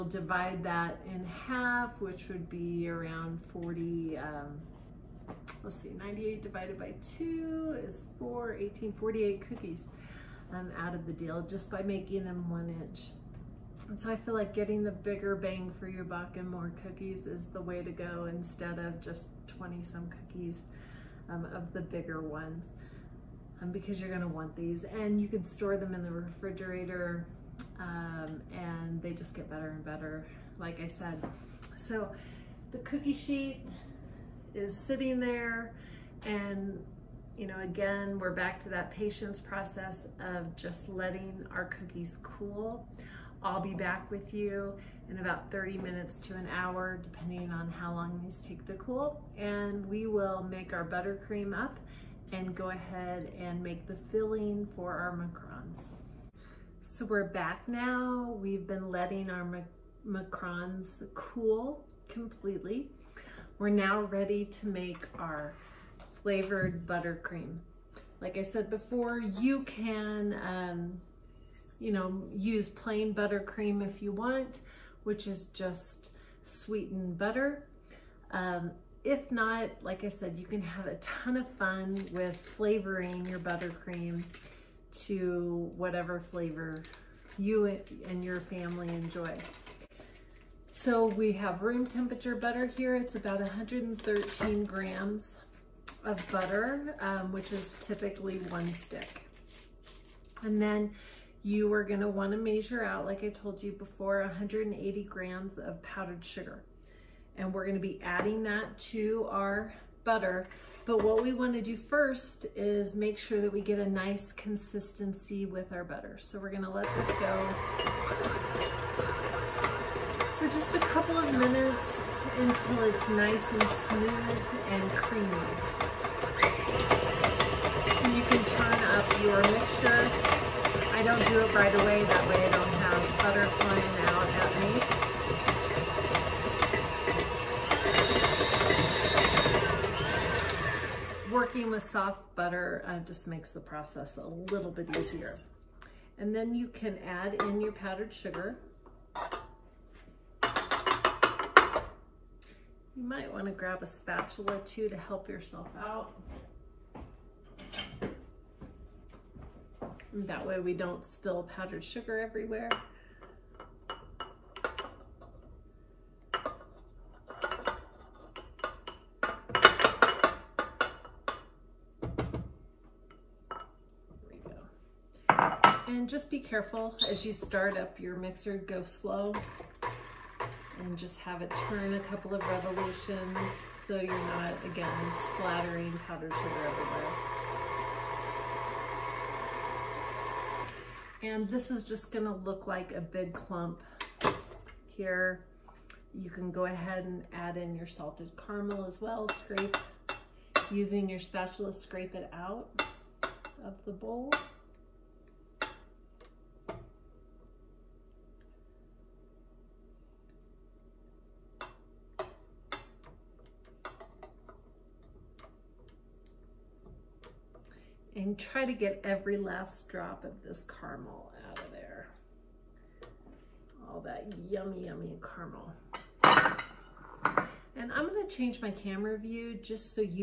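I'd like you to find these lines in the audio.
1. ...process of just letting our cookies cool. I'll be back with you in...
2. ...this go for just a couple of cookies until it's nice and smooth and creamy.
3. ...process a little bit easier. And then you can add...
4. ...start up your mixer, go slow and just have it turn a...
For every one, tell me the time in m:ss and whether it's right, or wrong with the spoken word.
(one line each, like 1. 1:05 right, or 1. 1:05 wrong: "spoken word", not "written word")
1. 0:39 right
2. 1:56 wrong: "minutes", not "cookies"
3. 2:23 right
4. 2:57 right.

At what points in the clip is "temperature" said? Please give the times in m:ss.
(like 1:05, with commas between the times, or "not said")
1:31.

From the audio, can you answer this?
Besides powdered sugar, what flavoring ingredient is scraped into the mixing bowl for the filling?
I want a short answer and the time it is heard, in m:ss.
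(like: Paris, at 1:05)
salted caramel, at 3:17.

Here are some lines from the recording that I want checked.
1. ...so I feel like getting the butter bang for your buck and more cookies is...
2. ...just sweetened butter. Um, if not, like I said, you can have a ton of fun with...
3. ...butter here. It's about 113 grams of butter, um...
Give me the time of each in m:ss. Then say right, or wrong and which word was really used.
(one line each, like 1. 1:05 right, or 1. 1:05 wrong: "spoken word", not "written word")
1. 0:13 wrong: "bigger", not "butter"
2. 1:15 right
3. 1:32 right.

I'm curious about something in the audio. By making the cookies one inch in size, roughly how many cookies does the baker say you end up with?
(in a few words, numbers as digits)
48.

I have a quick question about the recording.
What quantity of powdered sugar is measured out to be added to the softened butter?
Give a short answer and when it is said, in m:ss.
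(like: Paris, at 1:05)
180 grams, at 1:44.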